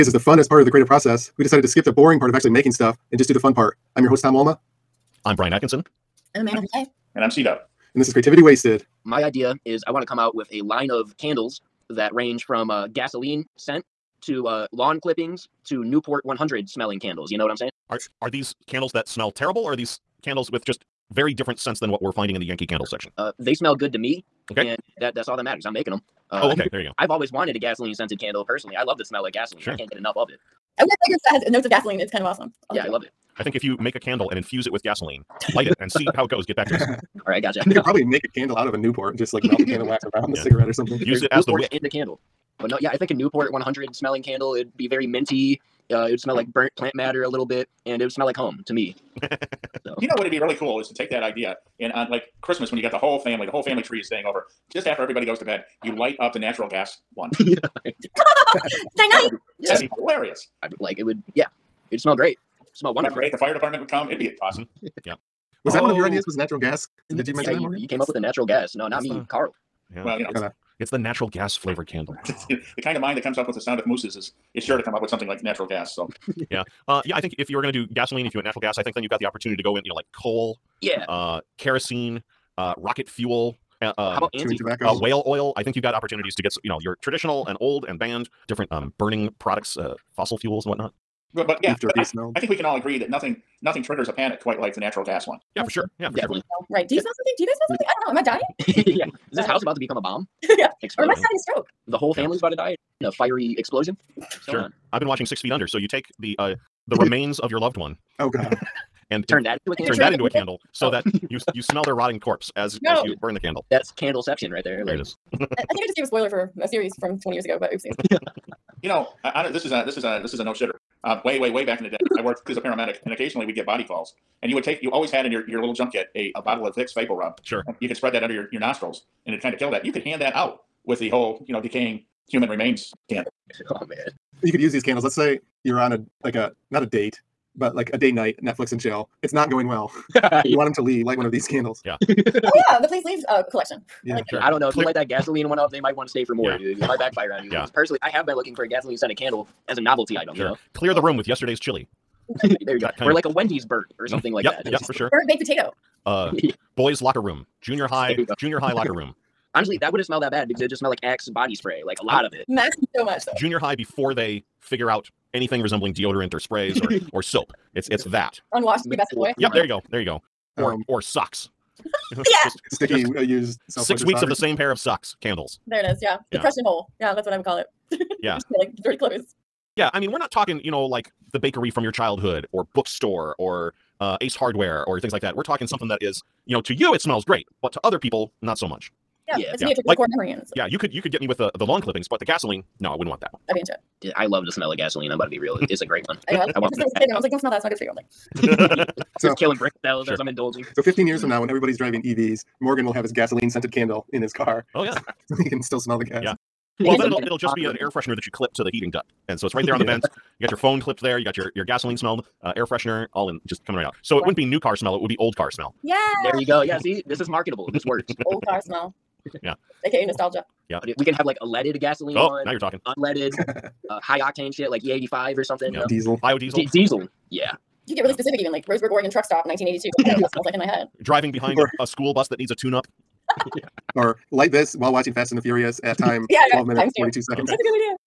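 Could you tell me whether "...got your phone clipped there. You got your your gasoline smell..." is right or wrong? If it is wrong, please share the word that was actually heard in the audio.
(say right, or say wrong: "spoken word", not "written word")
right.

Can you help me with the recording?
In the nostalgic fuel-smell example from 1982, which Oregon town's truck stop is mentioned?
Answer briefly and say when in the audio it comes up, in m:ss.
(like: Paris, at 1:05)
Roseburg, at 3:48.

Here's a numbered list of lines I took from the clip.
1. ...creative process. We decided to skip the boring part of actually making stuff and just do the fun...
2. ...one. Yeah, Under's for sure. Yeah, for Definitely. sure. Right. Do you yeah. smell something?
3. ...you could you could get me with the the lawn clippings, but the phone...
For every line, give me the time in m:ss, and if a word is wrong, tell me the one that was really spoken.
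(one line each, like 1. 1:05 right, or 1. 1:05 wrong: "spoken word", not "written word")
1. 0:00 right
2. 1:35 wrong: "That", not "Under"
3. 3:10 wrong: "gasoline", not "phone".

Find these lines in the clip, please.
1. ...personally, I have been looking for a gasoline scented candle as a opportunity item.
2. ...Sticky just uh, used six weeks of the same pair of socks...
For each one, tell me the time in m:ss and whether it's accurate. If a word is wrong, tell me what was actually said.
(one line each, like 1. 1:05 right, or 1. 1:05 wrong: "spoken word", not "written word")
1. 2:27 wrong: "novelty", not "opportunity"
2. 2:52 right.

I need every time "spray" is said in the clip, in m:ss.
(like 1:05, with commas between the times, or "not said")
2:41, 2:46.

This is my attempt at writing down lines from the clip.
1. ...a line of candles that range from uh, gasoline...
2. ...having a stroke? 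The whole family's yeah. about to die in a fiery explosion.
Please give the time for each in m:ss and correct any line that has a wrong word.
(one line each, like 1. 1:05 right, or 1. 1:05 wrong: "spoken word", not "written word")
1. 0:10 right
2. 1:41 right.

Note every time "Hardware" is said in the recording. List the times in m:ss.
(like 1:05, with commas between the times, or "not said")
3:04.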